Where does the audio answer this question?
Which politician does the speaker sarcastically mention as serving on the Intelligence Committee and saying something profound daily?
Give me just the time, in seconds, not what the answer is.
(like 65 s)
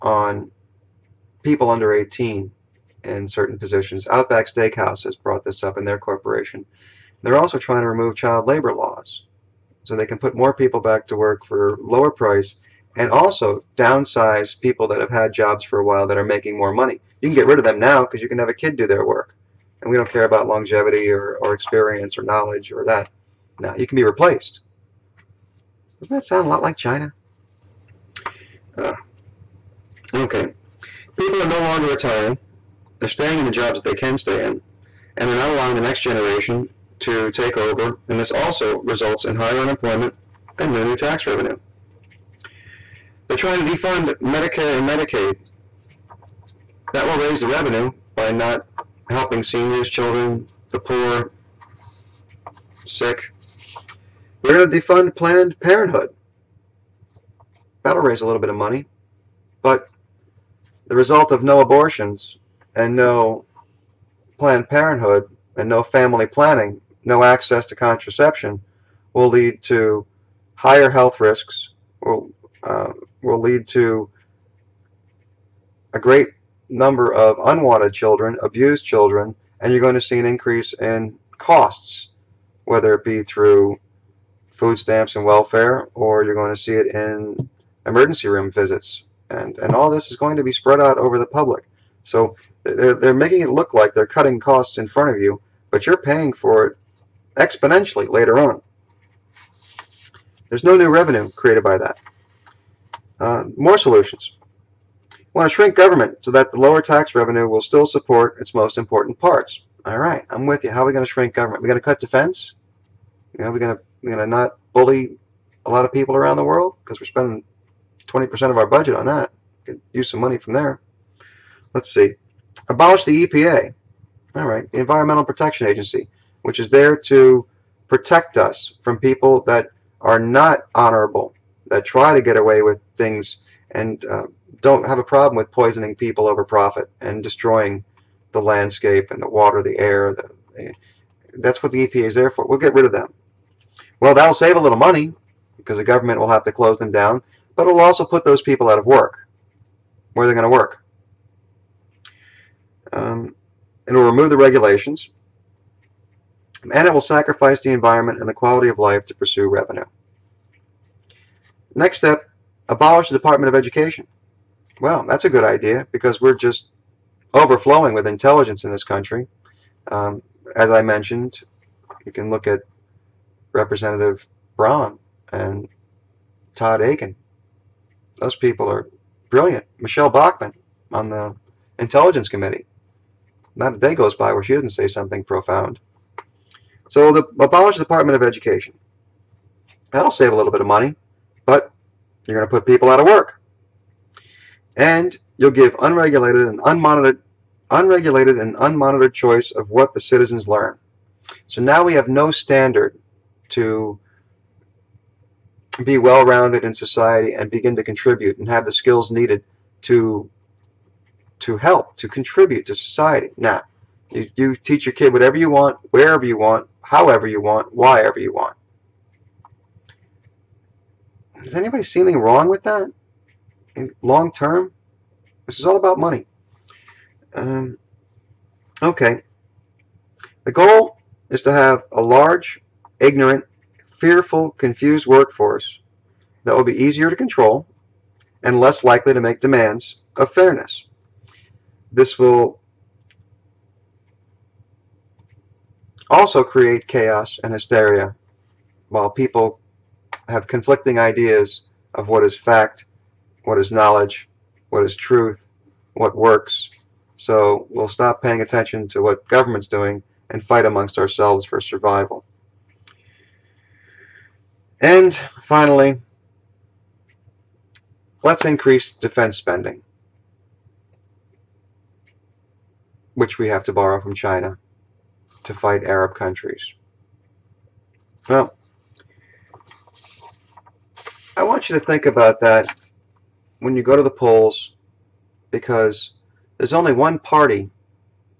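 179 s.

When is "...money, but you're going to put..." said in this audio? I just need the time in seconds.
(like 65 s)
190 s.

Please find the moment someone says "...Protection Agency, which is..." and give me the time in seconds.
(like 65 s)
125 s.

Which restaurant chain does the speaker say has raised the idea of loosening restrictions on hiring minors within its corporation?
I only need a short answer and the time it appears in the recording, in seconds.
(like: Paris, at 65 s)
Outback Steakhouse, at 4 s.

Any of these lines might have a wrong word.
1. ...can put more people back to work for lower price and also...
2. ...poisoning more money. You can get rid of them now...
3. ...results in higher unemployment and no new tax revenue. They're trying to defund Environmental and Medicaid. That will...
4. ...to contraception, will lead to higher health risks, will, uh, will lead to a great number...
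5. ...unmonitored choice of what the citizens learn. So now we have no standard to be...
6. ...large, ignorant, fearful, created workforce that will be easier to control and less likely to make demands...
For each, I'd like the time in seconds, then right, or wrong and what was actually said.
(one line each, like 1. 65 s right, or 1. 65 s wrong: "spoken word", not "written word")
1. 10 s right
2. 16 s wrong: "making", not "poisoning"
3. 38 s wrong: "Medicare", not "Environmental"
4. 67 s right
5. 198 s right
6. 232 s wrong: "confused", not "created".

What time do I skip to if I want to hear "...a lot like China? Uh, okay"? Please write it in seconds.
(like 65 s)
26 s.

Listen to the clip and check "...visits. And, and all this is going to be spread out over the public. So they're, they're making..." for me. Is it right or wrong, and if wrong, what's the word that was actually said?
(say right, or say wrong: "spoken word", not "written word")
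right.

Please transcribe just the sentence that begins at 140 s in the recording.
The, that's what the EPA is there for.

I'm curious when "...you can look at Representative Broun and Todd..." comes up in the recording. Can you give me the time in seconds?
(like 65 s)
172 s.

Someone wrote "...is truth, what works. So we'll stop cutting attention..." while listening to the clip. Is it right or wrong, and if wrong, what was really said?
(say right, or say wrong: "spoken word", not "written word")
wrong: "paying", not "cutting".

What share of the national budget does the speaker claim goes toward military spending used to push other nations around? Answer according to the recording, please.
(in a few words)
20%.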